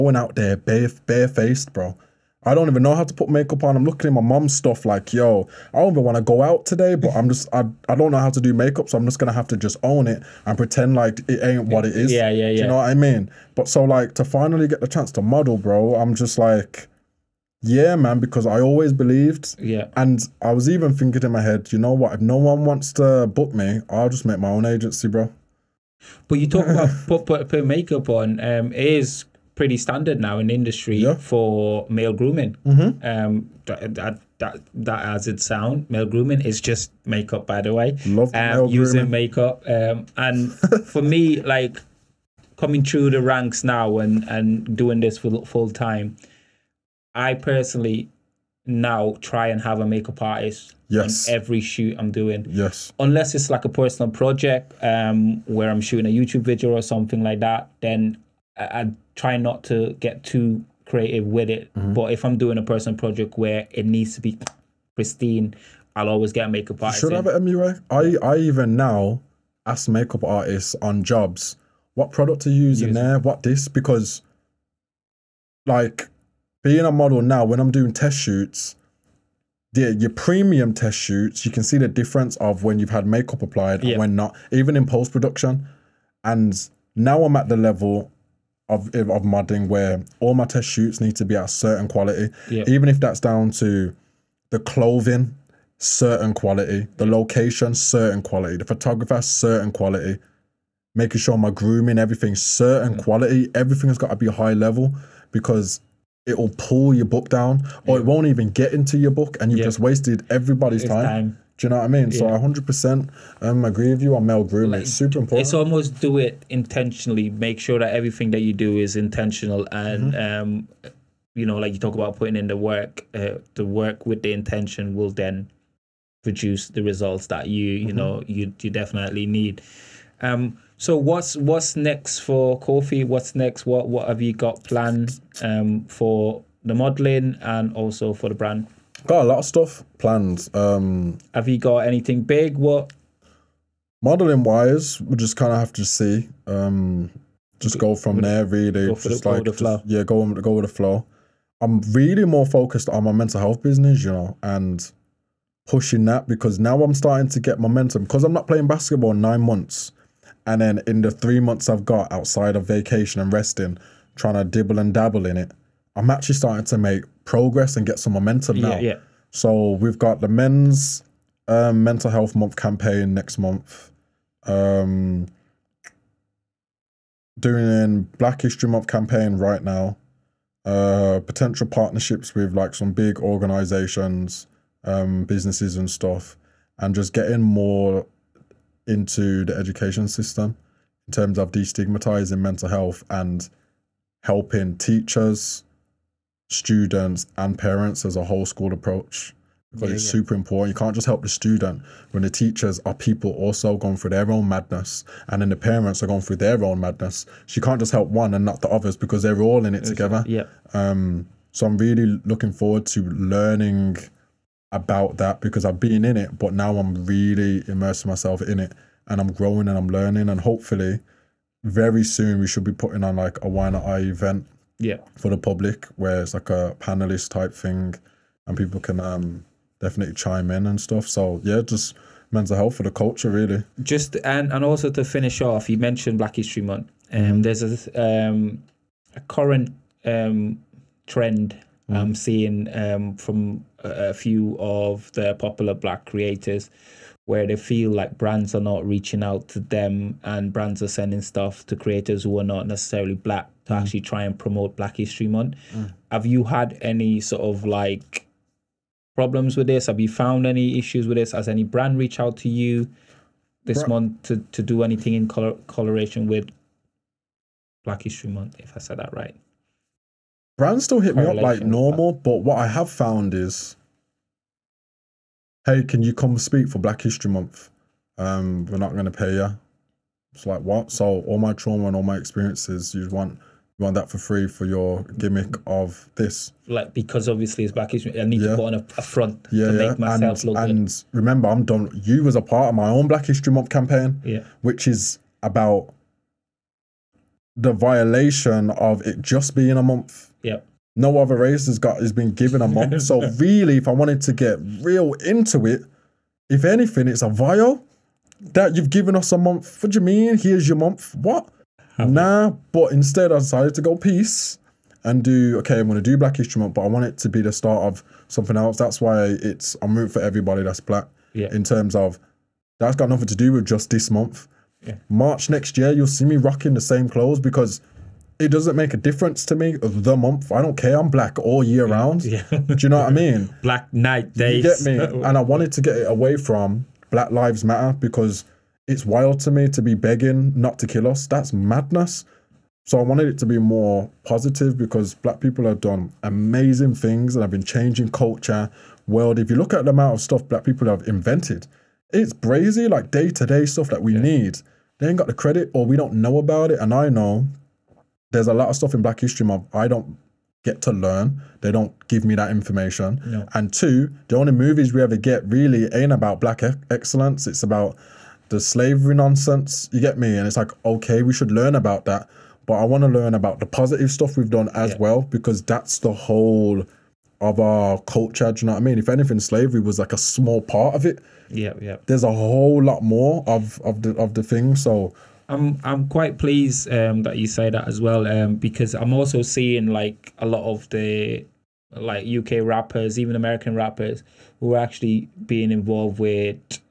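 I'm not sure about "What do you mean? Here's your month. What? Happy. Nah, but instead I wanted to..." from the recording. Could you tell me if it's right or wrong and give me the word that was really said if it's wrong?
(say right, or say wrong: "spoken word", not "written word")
wrong: "decided", not "wanted".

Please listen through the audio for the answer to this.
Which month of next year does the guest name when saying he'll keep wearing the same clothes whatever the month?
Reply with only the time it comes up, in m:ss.
5:25.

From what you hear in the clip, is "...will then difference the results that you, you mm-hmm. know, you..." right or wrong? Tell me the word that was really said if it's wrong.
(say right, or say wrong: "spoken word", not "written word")
wrong: "produce", not "difference".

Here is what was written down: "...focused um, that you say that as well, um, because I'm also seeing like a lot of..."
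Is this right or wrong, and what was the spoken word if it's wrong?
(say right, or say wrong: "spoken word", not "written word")
wrong: "pleased", not "focused".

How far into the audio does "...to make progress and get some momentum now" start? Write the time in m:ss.
2:46.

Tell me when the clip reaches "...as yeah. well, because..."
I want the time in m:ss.
6:14.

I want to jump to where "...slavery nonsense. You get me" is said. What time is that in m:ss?
6:08.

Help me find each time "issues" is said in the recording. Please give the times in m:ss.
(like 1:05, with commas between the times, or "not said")
4:20, 4:47.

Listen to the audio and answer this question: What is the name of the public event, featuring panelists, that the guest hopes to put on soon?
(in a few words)
Why Not I.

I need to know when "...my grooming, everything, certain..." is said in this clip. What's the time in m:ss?
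1:41.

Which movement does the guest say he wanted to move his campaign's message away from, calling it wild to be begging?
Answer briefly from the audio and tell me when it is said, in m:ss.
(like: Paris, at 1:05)
Black Lives Matter, at 5:37.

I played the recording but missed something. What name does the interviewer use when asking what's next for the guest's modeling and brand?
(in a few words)
Kofi.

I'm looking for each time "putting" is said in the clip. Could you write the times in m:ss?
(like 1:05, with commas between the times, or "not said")
2:02, 3:42.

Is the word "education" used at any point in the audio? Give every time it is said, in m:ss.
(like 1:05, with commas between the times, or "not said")
3:09.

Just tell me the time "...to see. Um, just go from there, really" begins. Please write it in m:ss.
2:25.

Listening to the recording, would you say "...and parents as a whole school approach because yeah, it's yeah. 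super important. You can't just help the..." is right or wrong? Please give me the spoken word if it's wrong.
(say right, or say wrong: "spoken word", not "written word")
right.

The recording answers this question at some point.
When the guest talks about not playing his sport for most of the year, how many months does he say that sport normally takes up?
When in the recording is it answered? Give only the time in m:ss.
2:39.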